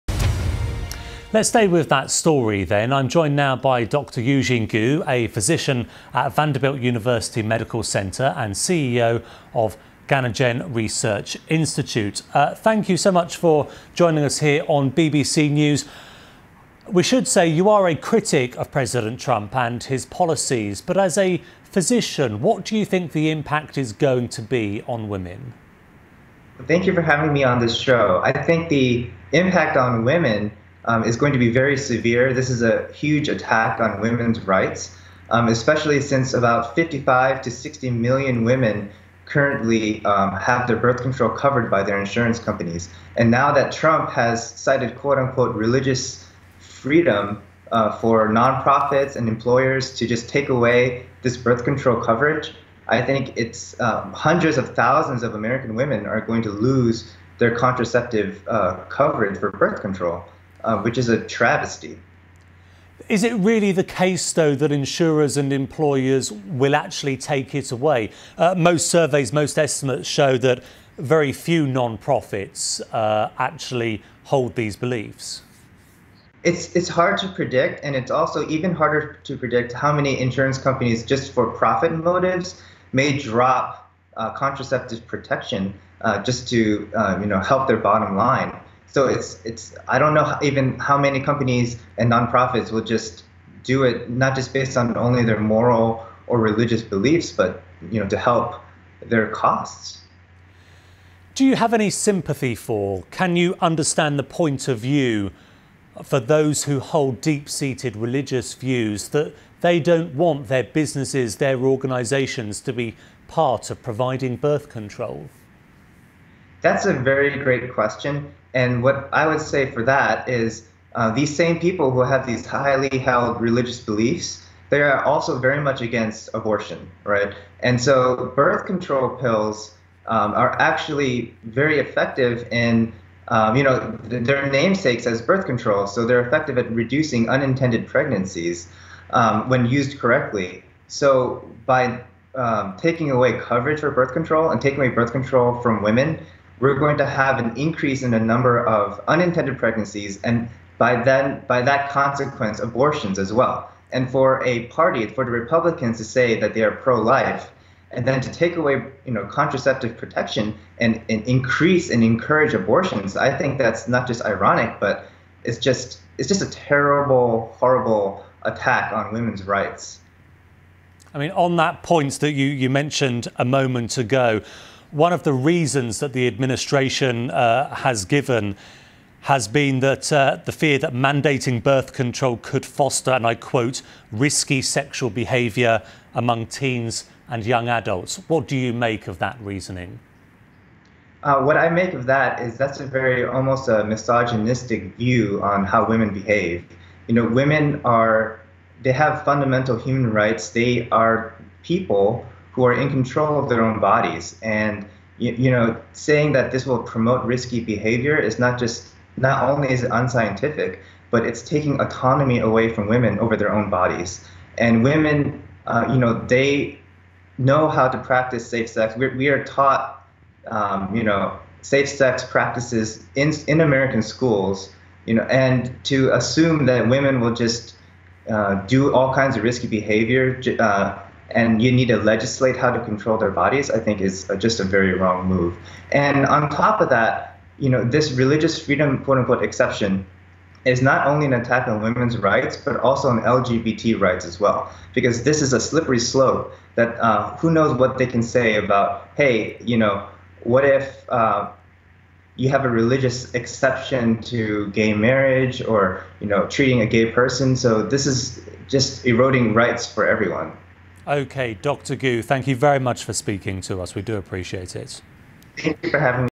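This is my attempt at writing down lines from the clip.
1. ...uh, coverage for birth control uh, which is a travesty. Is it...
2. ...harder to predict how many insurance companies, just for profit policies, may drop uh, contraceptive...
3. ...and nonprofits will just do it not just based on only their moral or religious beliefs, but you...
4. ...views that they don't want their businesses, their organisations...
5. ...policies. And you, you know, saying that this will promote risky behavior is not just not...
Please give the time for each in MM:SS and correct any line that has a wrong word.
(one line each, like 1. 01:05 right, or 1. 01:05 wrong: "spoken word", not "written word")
1. 00:58 right
2. 01:18 wrong: "motives", not "policies"
3. 01:31 right
4. 01:48 right
5. 03:23 wrong: "bodies", not "policies".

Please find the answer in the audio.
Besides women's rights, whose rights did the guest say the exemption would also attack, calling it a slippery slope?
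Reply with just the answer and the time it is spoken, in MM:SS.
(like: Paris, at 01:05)
LGBT rights, at 04:03.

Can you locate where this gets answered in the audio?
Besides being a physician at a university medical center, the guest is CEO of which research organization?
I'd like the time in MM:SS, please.
00:10.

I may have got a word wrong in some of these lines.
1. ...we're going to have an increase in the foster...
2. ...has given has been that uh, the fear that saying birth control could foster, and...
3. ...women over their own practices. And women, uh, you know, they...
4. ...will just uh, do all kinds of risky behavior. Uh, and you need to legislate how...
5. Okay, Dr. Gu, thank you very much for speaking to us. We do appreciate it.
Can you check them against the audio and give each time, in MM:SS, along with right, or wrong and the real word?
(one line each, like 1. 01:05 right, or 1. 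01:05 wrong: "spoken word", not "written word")
1. 02:26 wrong: "number", not "foster"
2. 02:57 wrong: "mandating", not "saying"
3. 03:32 wrong: "bodies", not "practices"
4. 03:47 right
5. 04:21 right.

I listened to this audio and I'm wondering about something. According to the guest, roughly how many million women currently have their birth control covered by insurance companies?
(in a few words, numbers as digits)
55 to 60 million.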